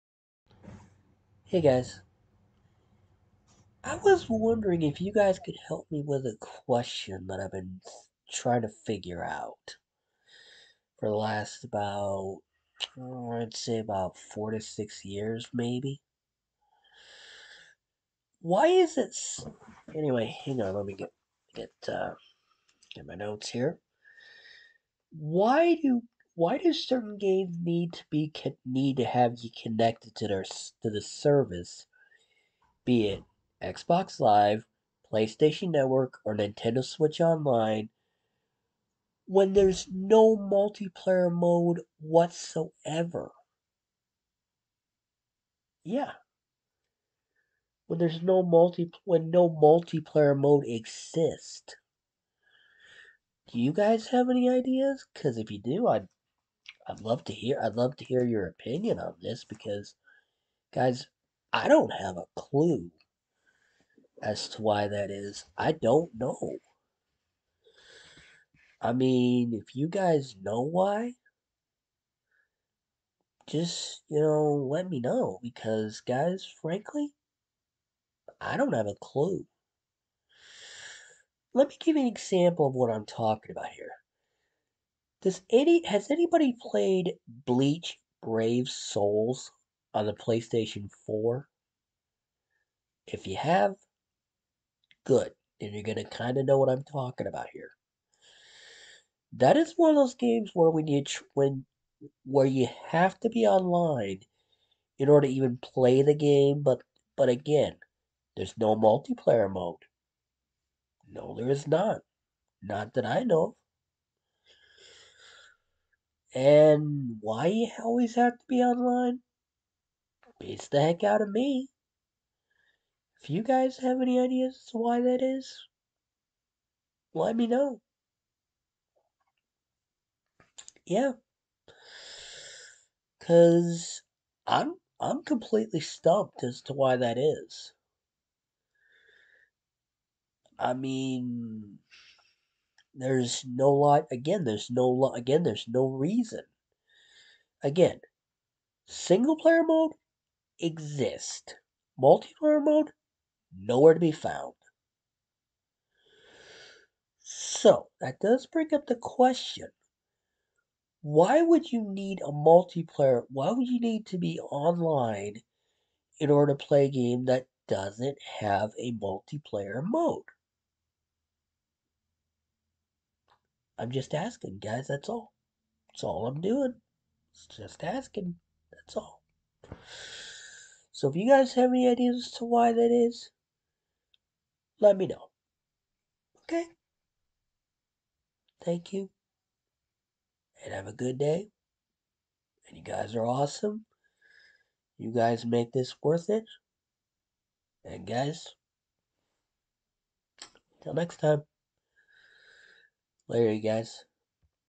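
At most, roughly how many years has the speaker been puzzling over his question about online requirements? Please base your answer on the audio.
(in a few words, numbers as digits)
6.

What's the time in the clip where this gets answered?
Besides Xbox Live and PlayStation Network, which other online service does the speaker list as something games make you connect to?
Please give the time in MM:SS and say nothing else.
00:36.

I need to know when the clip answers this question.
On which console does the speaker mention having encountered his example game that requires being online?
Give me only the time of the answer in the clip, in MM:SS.
01:30.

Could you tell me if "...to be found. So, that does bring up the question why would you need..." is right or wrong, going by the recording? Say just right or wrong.
right.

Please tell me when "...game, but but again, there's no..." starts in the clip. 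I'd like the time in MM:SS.
01:46.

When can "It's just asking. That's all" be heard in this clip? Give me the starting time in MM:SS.
02:57.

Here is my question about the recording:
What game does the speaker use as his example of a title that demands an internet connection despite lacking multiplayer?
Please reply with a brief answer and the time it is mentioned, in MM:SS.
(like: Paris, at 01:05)
Bleach Brave Souls, at 01:27.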